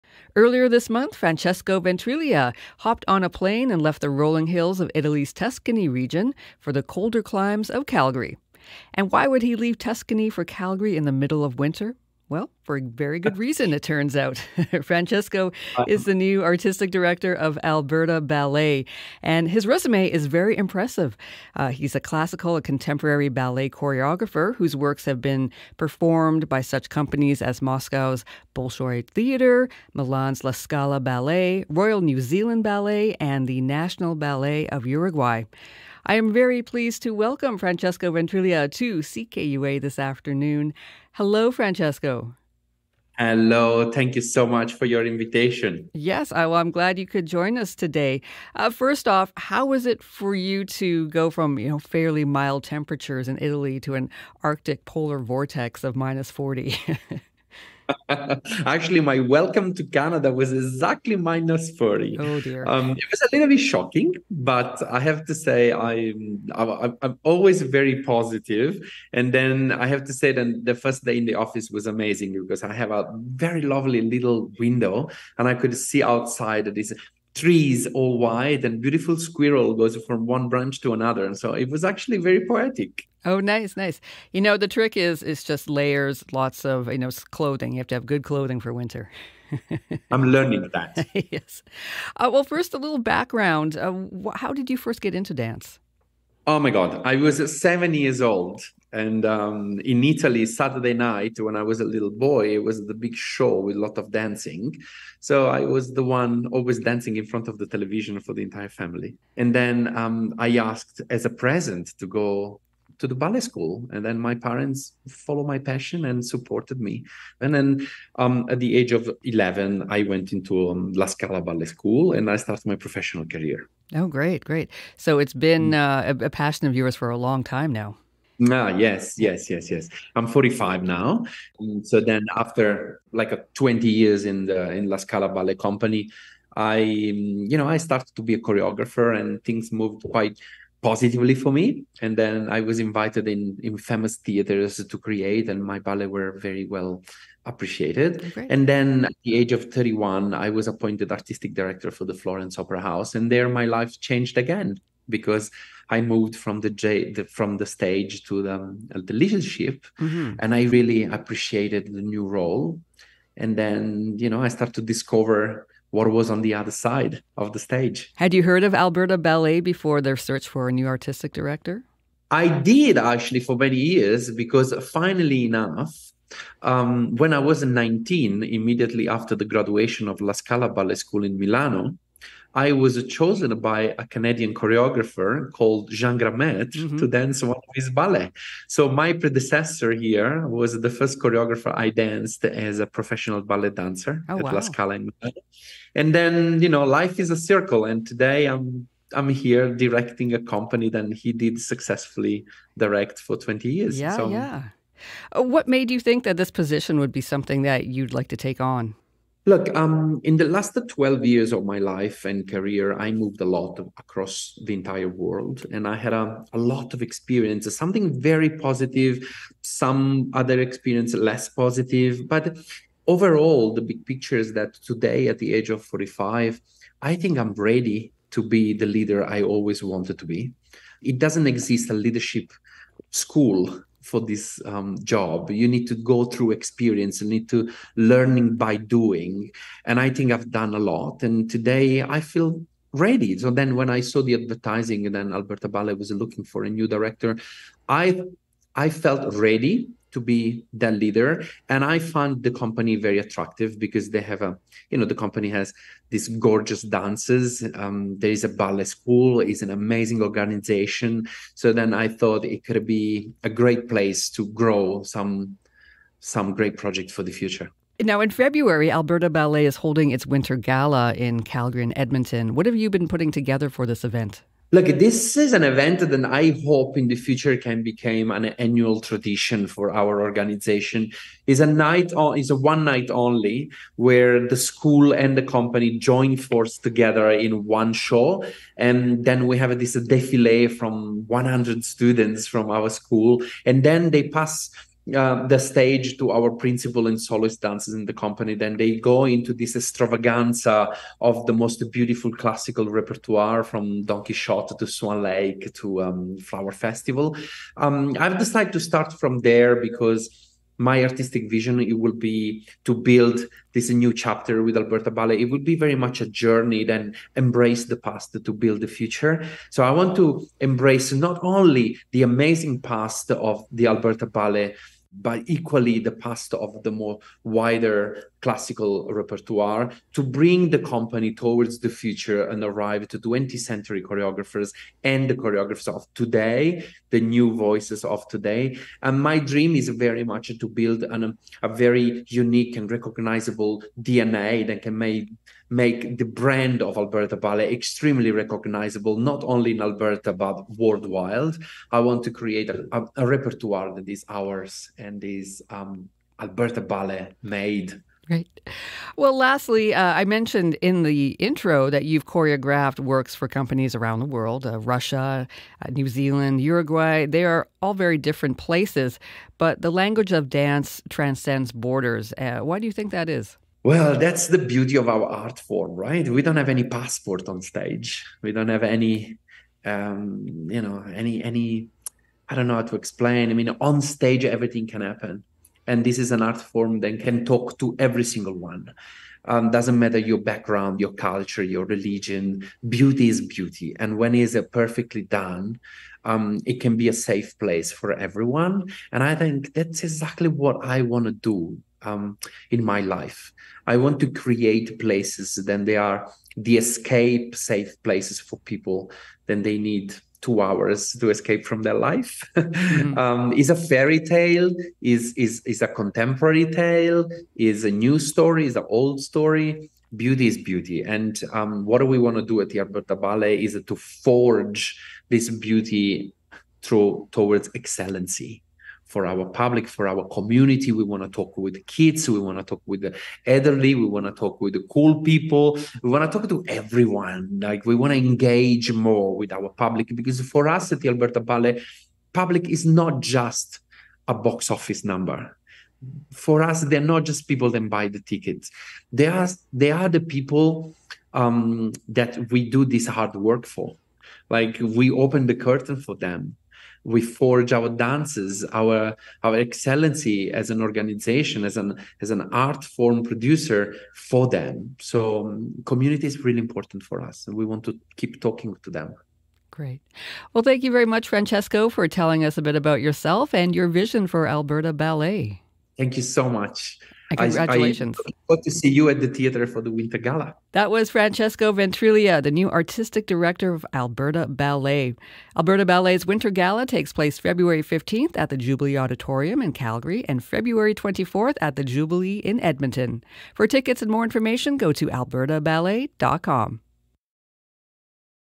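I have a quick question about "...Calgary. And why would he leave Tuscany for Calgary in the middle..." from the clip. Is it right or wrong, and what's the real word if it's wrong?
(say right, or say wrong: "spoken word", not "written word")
right.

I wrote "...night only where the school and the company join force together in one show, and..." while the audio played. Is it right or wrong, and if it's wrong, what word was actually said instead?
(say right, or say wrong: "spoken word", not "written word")
right.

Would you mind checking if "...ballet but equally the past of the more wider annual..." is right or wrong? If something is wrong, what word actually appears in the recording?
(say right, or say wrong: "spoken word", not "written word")
wrong: "classical", not "annual".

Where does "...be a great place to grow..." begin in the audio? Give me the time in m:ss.
4:22.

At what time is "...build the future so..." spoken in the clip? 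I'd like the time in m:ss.
5:18.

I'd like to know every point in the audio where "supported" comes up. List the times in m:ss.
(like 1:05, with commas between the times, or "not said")
1:56.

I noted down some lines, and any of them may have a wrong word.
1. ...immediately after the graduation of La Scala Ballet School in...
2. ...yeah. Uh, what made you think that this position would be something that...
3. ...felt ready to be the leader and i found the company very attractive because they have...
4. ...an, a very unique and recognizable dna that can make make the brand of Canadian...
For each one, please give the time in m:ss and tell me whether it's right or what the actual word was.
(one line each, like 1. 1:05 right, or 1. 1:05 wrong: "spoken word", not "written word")
1. 2:58 right
2. 3:24 right
3. 4:08 right
4. 5:41 wrong: "Alberta", not "Canadian".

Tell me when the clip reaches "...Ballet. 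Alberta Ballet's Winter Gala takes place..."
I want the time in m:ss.
8:04.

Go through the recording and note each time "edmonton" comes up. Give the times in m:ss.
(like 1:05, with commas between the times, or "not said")
4:31, 8:12.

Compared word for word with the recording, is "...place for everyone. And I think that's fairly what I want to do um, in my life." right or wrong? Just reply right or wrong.
wrong.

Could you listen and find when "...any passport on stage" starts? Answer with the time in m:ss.
6:16.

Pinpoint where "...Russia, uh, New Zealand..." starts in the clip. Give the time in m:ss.
6:04.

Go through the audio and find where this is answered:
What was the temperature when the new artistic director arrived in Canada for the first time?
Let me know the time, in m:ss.
1:01.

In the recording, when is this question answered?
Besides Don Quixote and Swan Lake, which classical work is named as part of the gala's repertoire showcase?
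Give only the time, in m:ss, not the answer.
5:06.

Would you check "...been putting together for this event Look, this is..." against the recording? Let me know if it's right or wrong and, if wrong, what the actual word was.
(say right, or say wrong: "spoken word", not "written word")
right.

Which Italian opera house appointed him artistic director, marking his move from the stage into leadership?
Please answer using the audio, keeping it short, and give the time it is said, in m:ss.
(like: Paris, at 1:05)
Florence Opera House, at 2:32.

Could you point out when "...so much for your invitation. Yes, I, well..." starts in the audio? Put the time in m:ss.
0:44.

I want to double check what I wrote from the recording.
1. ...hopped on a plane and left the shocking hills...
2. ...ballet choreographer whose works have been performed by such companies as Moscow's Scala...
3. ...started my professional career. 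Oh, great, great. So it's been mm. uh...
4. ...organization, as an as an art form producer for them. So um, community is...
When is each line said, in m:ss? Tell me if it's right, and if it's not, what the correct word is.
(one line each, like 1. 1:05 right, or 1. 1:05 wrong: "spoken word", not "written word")
1. 0:02 wrong: "rolling", not "shocking"
2. 0:23 wrong: "Bolshoi", not "Scala"
3. 2:02 right
4. 7:40 right.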